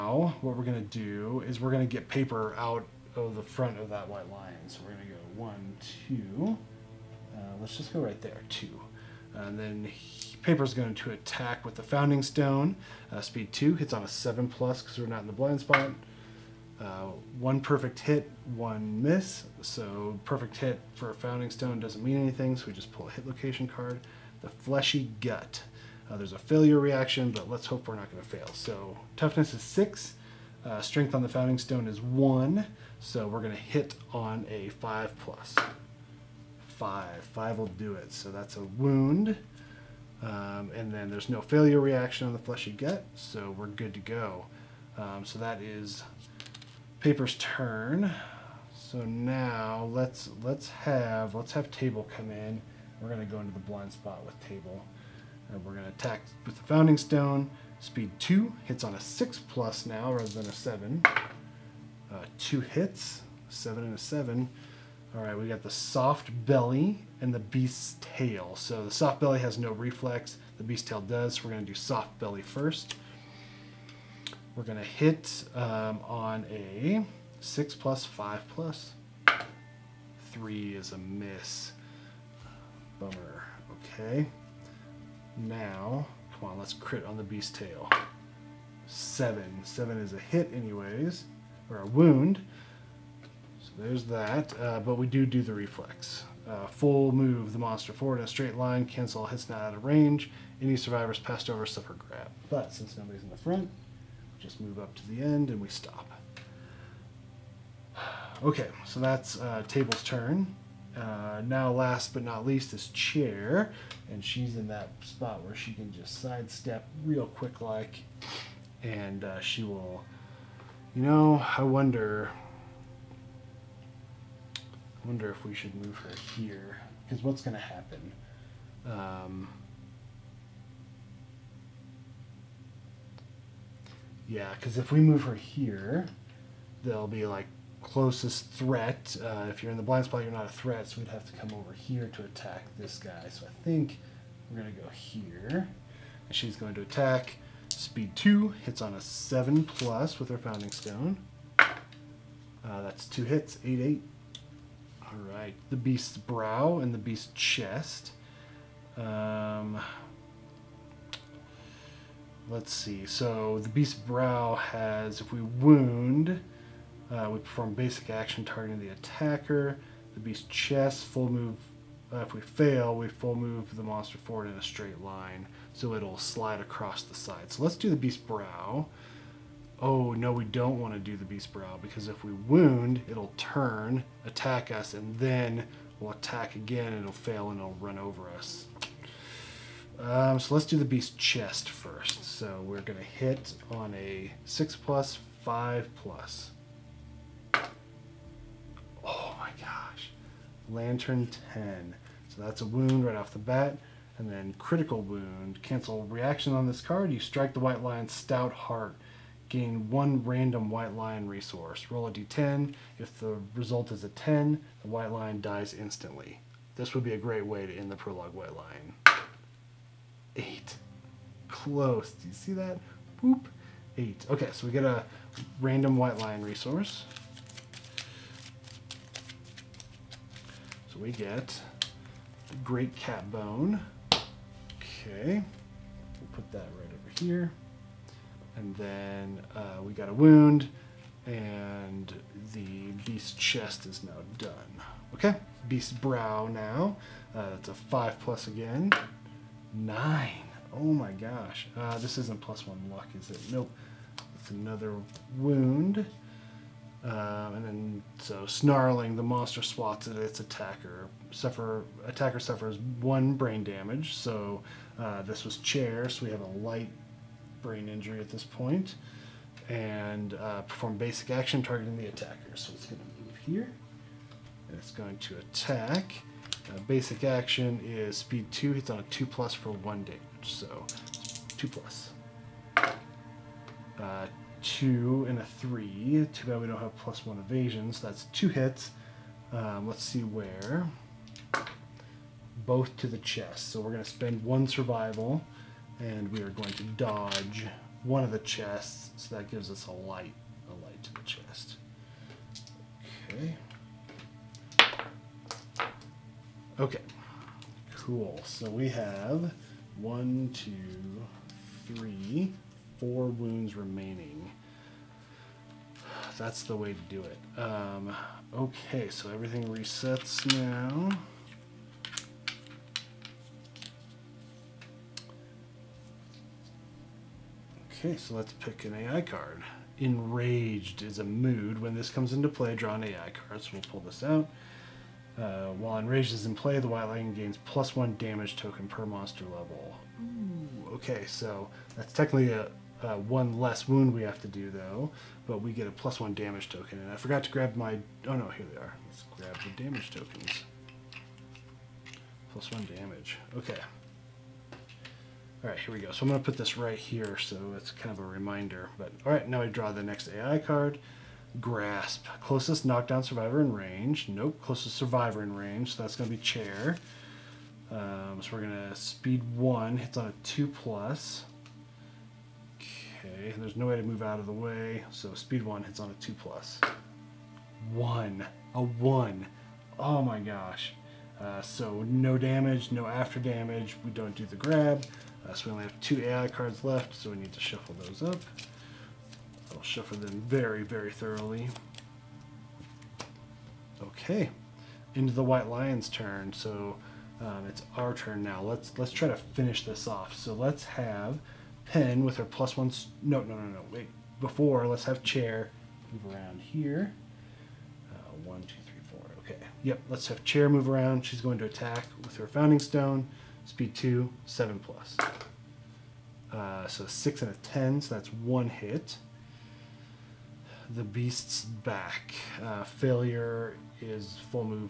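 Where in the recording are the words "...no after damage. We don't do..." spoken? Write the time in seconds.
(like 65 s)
382 s.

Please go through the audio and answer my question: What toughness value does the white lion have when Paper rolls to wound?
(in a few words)
6.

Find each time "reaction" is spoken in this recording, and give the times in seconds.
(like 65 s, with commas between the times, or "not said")
26 s, 41 s, 206 s.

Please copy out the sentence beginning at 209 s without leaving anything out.
Gain one random white lion resource.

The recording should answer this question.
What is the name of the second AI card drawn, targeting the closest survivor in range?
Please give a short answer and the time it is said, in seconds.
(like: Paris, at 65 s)
Grasp, at 361 s.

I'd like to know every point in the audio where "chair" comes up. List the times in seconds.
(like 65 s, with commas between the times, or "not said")
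112 s, 265 s, 366 s, 405 s, 410 s.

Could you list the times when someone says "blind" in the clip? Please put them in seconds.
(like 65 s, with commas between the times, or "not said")
15 s, 53 s, 139 s.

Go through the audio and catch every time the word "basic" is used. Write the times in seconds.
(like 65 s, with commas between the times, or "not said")
167 s, 270 s, 276 s.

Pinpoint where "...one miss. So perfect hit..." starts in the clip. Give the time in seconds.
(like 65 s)
18 s.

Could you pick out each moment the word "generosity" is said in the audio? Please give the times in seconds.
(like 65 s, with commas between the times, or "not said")
not said.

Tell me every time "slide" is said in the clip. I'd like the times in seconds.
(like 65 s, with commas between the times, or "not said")
176 s.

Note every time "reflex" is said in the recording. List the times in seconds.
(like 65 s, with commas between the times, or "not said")
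69 s, 95 s.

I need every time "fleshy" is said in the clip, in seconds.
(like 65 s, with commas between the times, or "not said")
24 s, 42 s.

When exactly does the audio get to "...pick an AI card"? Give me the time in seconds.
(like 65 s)
328 s.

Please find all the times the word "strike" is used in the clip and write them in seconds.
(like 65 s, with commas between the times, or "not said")
207 s.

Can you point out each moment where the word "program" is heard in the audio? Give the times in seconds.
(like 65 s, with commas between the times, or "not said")
not said.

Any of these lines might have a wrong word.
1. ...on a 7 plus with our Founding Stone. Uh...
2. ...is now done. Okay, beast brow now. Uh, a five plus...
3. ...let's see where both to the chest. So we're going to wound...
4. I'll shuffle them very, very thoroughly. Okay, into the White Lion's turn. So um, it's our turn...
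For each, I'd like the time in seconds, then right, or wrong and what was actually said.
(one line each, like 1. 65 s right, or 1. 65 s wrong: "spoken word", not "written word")
1. 148 s right
2. 243 s right
3. 289 s wrong: "spend", not "wound"
4. 389 s right.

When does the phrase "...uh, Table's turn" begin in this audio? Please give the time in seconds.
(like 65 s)
109 s.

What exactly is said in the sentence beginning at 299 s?
So that gives us a light, a light to the chest.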